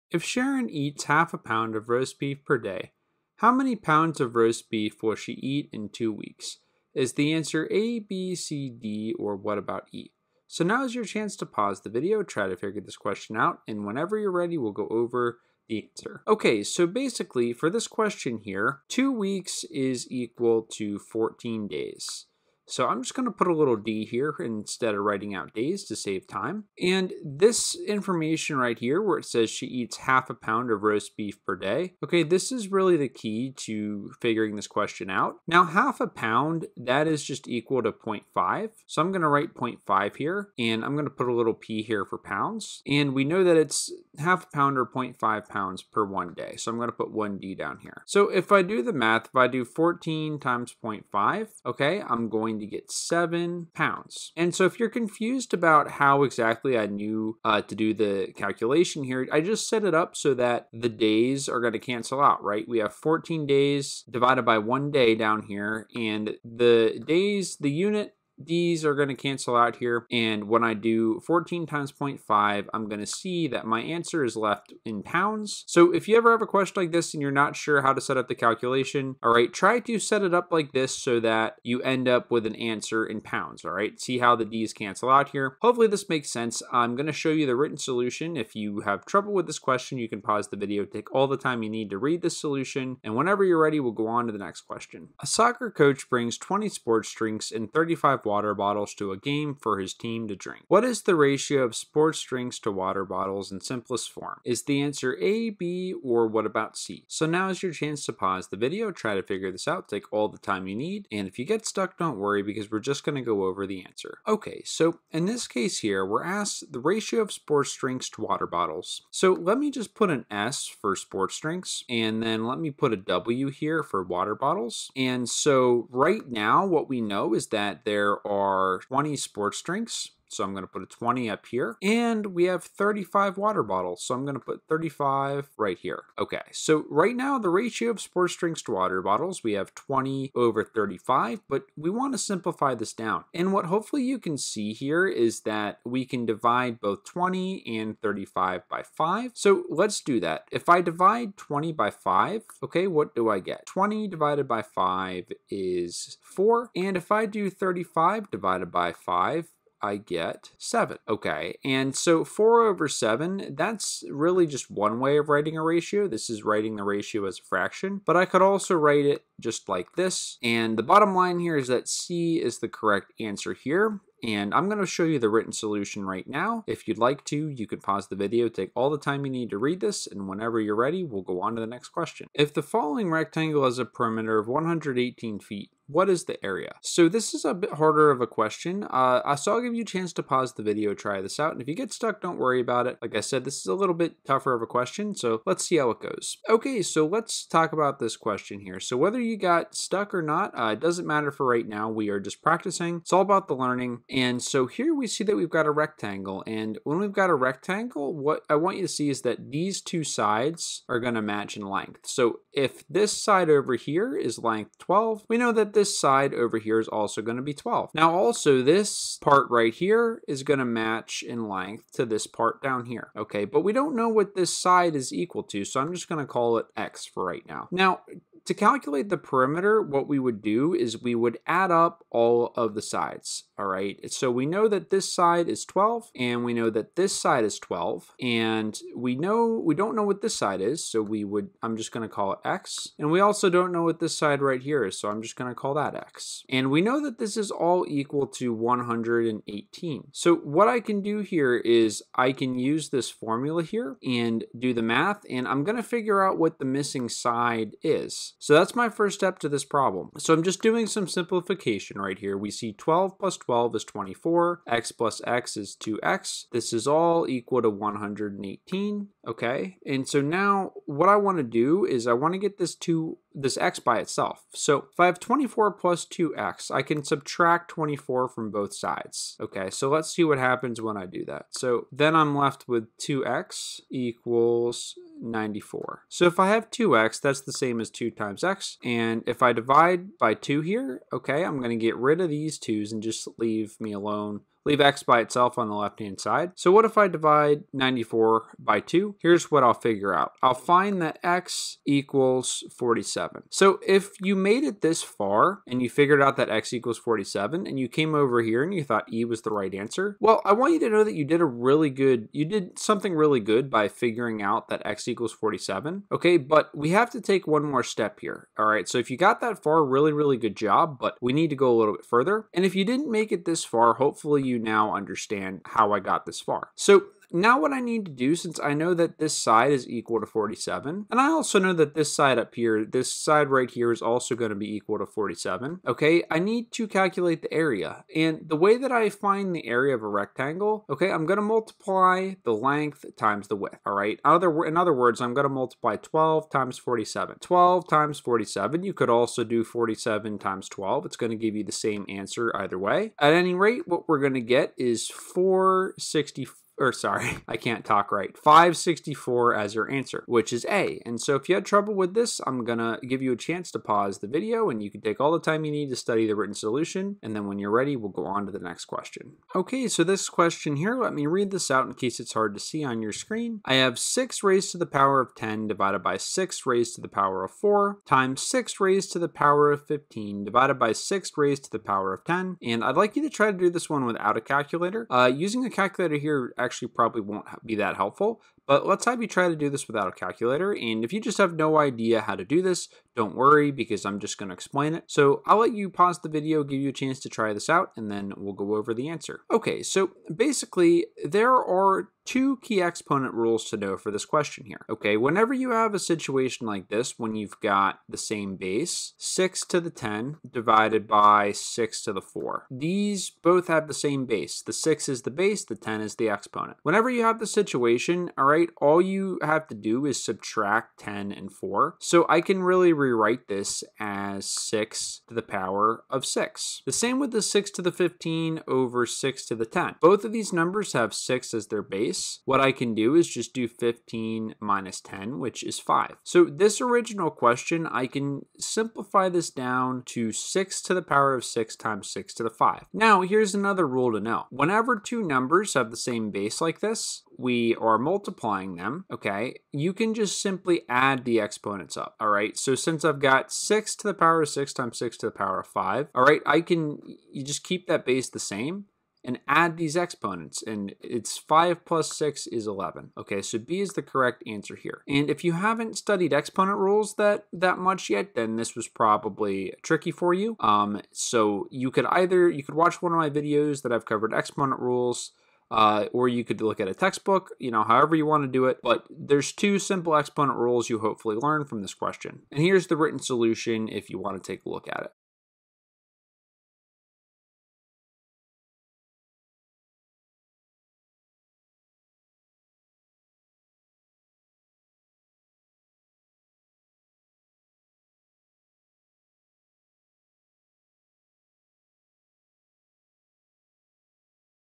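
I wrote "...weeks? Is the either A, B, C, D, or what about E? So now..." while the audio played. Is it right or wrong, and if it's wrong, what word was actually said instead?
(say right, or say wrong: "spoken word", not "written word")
wrong: "answer", not "either".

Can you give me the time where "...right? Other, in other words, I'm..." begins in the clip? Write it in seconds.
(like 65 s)
343 s.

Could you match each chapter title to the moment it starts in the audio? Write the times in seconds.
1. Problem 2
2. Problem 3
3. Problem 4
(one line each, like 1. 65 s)
1. 95 s
2. 182 s
3. 369 s.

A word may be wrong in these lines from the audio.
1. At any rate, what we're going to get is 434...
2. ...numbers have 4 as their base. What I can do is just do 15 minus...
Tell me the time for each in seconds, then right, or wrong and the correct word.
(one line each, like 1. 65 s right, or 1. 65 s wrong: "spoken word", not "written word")
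1. 353 s wrong: "464", not "434"
2. 430 s wrong: "6", not "4".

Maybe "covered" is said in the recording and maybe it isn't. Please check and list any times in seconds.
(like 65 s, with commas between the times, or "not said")
474 s.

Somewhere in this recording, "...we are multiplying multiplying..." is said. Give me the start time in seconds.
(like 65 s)
447 s.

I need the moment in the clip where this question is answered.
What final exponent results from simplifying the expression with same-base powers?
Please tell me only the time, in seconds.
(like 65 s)
462 s.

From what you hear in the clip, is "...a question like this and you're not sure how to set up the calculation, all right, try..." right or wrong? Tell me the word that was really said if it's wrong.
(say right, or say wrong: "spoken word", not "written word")
right.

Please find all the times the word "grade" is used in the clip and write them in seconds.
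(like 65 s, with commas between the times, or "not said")
not said.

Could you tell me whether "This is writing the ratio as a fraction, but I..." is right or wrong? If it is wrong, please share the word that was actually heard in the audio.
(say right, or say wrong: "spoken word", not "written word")
right.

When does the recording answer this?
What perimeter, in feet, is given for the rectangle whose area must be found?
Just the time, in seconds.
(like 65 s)
184 s.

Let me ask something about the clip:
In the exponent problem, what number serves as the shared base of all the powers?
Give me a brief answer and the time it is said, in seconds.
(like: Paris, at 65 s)
6, at 414 s.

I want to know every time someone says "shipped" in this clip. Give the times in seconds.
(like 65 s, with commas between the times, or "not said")
not said.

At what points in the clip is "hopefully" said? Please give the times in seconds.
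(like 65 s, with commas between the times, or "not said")
85 s, 143 s, 323 s, 480 s.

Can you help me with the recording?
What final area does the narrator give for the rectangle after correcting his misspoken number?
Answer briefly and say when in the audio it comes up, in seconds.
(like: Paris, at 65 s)
564, at 358 s.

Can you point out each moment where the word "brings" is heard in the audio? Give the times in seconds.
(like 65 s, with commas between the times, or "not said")
96 s.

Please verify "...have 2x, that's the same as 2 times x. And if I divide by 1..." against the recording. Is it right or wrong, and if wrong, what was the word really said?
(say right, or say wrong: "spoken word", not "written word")
wrong: "2", not "1".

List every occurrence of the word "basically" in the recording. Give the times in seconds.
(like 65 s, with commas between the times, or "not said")
16 s, 400 s.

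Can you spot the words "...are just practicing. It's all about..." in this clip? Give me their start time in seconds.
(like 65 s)
202 s.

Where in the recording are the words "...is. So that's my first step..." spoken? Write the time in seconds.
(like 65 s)
257 s.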